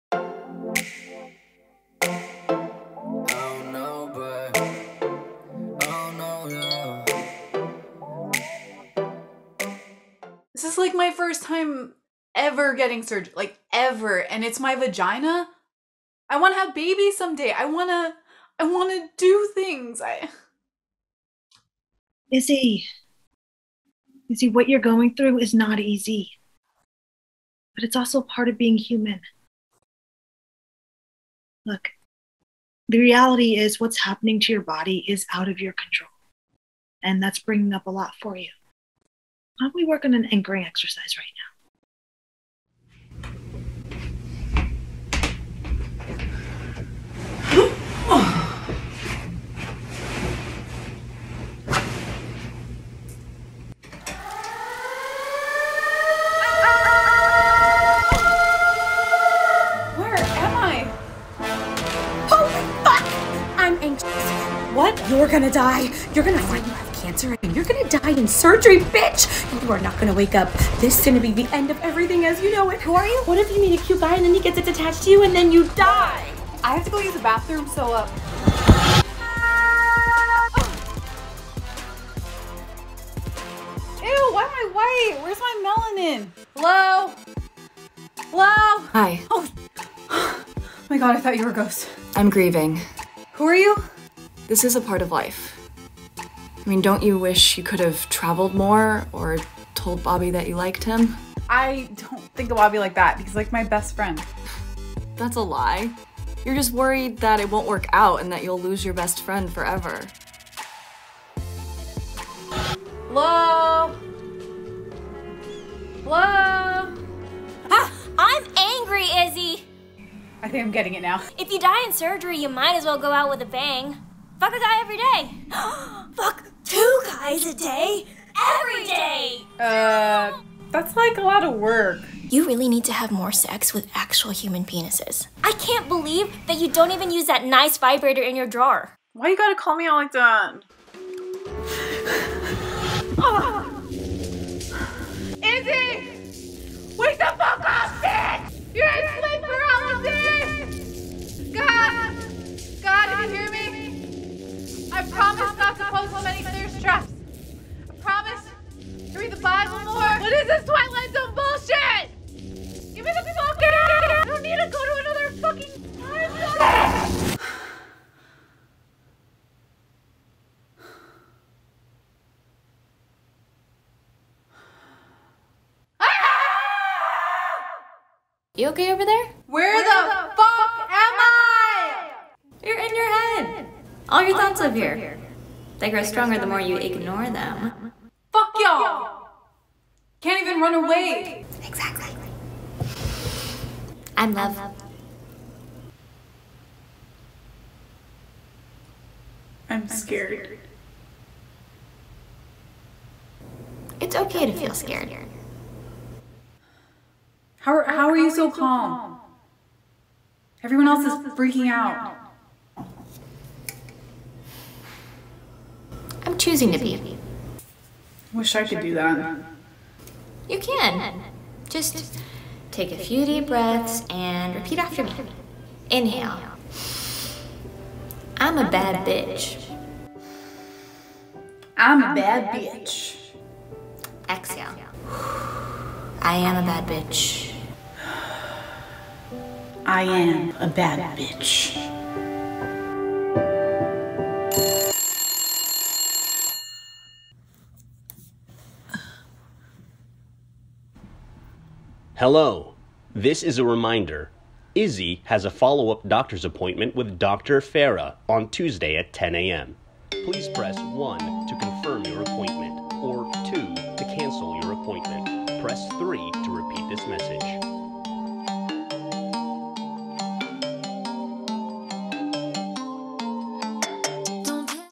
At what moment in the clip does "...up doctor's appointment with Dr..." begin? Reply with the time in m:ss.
4:15.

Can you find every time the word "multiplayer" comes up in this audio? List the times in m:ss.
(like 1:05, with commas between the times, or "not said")
not said.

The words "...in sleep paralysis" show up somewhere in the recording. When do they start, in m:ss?
2:28.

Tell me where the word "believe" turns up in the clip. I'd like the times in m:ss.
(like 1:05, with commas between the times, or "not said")
2:15.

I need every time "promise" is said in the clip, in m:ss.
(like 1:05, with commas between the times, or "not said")
2:35.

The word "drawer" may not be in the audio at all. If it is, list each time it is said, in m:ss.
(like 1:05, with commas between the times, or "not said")
2:18.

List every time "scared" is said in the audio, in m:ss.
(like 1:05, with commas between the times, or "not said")
3:19, 3:24.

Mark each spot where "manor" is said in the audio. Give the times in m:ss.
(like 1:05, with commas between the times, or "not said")
not said.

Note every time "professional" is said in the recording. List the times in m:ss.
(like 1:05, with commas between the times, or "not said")
not said.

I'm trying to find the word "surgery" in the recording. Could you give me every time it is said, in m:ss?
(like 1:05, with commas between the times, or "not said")
0:13, 1:08, 2:01.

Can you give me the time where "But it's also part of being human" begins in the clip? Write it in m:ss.
0:27.